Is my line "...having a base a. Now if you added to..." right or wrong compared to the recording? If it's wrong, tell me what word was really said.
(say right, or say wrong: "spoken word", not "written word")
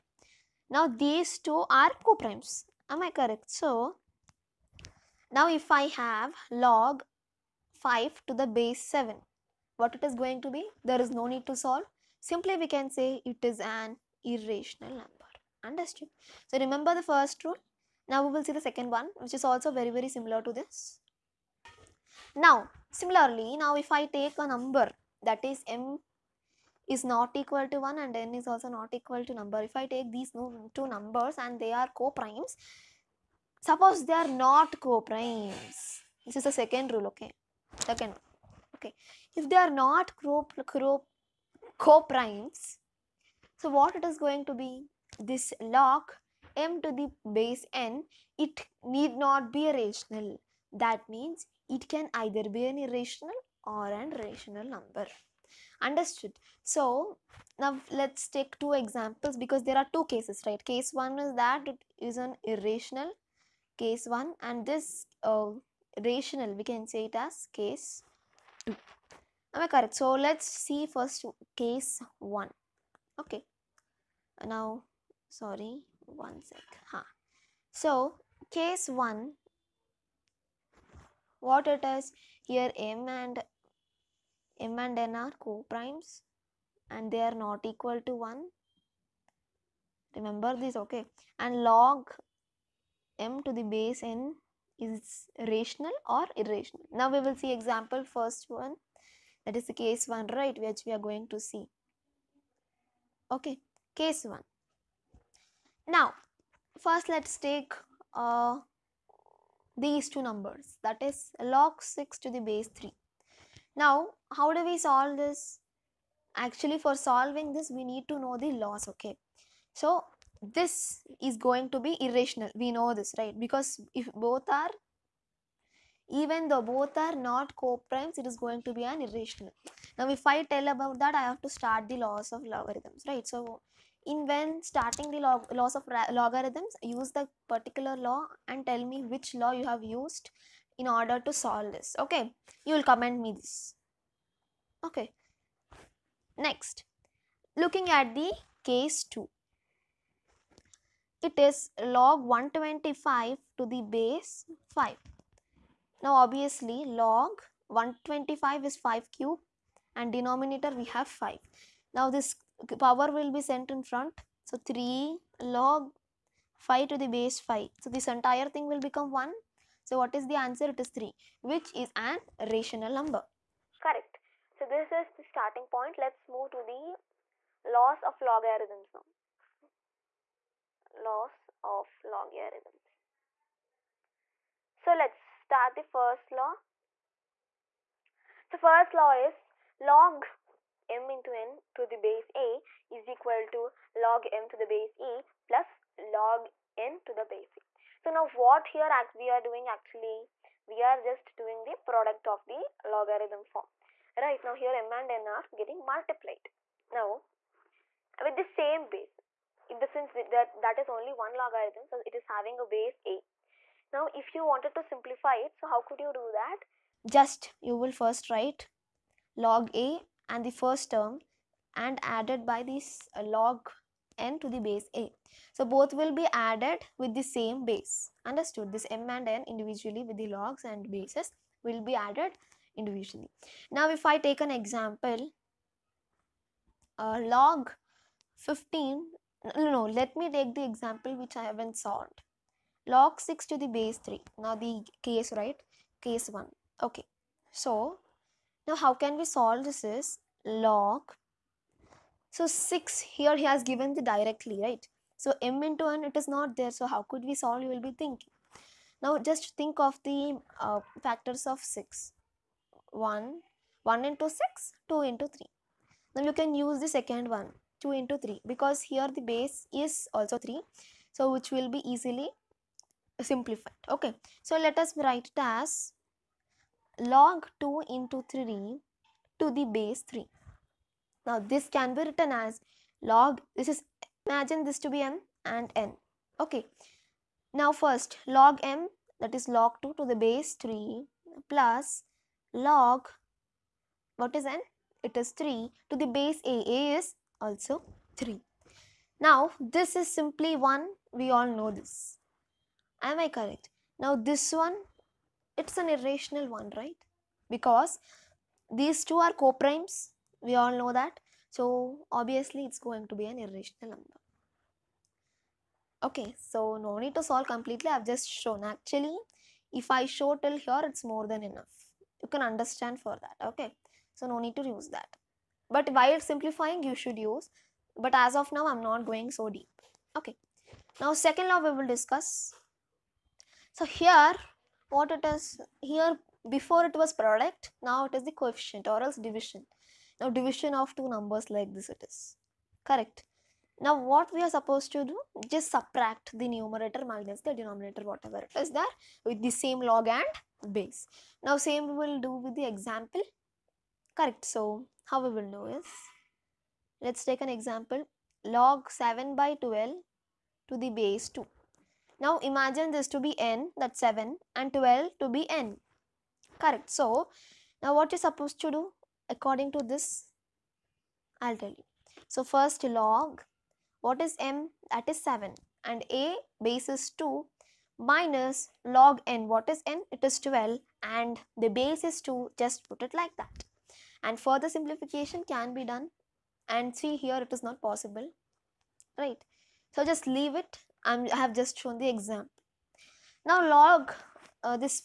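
wrong: "wanted", not "added".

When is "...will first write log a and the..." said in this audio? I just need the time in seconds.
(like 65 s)
217 s.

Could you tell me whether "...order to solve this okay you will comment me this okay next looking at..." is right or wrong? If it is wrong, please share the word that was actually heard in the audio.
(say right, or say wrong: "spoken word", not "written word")
right.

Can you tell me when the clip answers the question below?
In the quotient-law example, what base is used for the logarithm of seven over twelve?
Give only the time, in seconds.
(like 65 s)
360 s.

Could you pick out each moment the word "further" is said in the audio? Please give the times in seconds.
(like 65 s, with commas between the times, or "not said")
384 s.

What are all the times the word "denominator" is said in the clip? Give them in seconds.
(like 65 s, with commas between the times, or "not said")
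160 s, 347 s.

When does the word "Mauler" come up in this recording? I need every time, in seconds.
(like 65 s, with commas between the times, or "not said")
not said.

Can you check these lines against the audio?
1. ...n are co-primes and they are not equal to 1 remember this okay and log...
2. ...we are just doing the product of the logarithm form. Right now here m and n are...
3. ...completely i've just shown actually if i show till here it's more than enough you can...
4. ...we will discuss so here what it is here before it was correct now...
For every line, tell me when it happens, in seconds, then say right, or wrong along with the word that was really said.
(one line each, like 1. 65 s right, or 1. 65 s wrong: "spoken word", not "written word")
1. 84 s right
2. 200 s right
3. 317 s right
4. 331 s wrong: "product", not "correct".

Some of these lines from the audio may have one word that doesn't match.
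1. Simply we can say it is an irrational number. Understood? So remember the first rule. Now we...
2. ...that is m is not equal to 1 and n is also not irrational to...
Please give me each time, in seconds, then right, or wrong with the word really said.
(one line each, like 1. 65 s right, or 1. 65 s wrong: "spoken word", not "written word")
1. 12 s right
2. 25 s wrong: "equal", not "irrational".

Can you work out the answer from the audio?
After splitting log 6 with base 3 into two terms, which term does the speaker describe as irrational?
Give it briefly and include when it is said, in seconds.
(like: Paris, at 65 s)
log 2 to the base 3, at 289 s.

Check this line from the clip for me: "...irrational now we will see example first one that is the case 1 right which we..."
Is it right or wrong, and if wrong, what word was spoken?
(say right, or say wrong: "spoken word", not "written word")
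right.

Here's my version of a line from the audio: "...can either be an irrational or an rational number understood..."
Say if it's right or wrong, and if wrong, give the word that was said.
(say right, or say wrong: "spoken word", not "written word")
right.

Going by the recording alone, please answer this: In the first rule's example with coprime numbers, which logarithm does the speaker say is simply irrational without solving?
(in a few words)
log 5 to the base 7.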